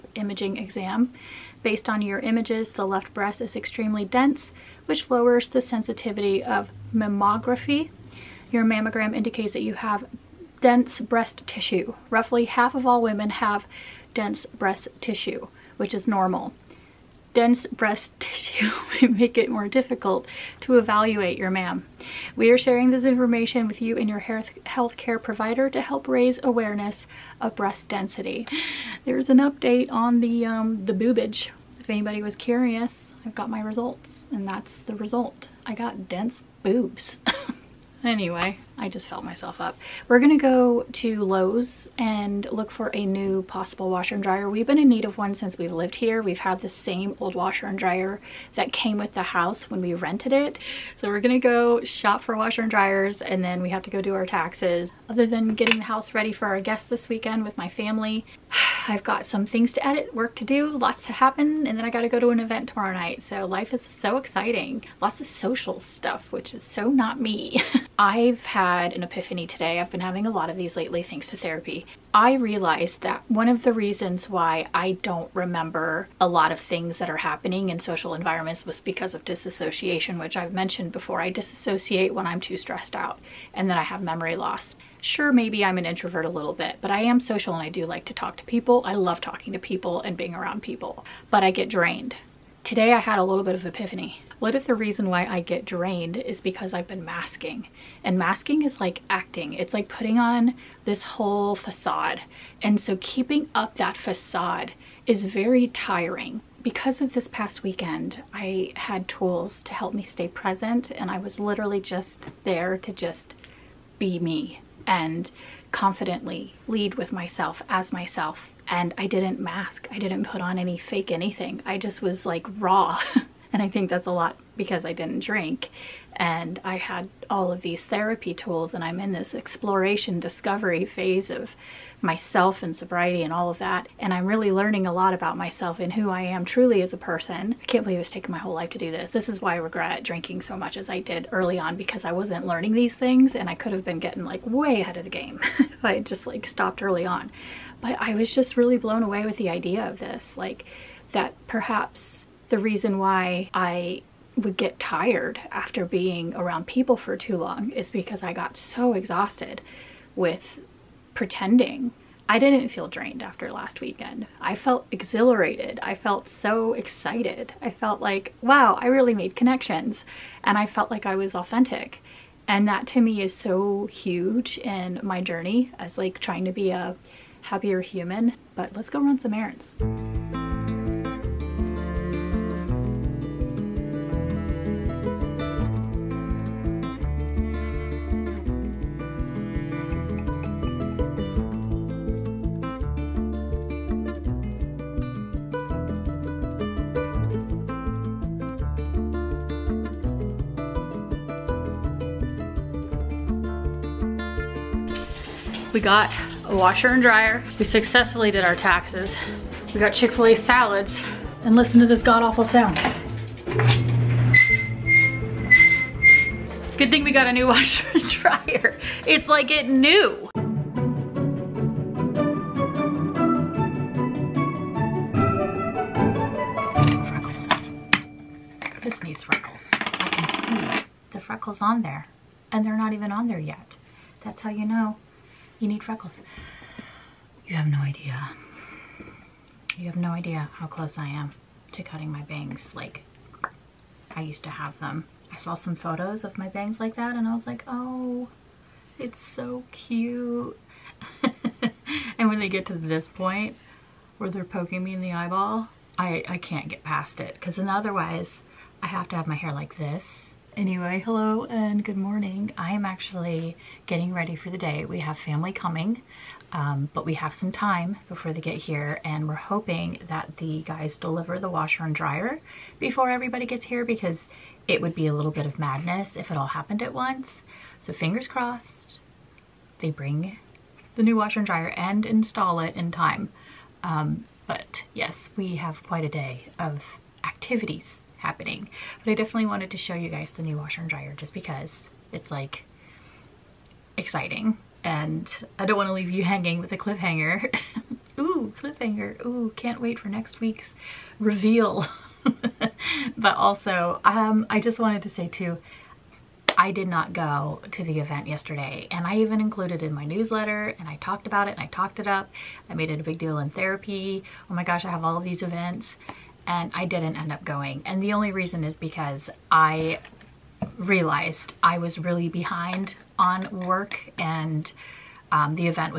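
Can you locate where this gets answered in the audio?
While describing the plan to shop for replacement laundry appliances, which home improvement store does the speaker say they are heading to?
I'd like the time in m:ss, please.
0:41.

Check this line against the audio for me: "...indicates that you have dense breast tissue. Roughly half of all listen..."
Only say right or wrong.
wrong.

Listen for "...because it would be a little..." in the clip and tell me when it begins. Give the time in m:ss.
4:33.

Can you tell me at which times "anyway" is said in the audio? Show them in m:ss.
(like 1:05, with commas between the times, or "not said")
0:38, 4:20.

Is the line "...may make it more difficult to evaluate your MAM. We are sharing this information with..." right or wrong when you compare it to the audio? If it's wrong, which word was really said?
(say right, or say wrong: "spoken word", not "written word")
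right.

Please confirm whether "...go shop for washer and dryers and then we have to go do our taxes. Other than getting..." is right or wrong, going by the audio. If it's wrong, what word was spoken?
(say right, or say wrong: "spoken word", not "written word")
right.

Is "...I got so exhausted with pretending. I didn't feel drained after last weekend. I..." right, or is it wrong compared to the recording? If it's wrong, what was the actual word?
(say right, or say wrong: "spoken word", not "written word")
right.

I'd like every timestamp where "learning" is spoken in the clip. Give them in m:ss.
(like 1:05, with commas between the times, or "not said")
2:14, 2:22.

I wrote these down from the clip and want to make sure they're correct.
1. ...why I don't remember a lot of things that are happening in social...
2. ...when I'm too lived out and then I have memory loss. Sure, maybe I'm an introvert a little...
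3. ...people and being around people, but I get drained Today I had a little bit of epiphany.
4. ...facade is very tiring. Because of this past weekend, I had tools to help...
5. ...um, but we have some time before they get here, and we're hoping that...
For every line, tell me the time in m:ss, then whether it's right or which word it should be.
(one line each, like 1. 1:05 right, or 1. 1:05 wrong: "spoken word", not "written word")
1. 1:14 right
2. 1:22 wrong: "stressed", not "lived"
3. 1:29 right
4. 1:43 right
5. 4:26 right.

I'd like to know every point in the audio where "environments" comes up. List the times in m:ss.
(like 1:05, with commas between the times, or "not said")
1:18.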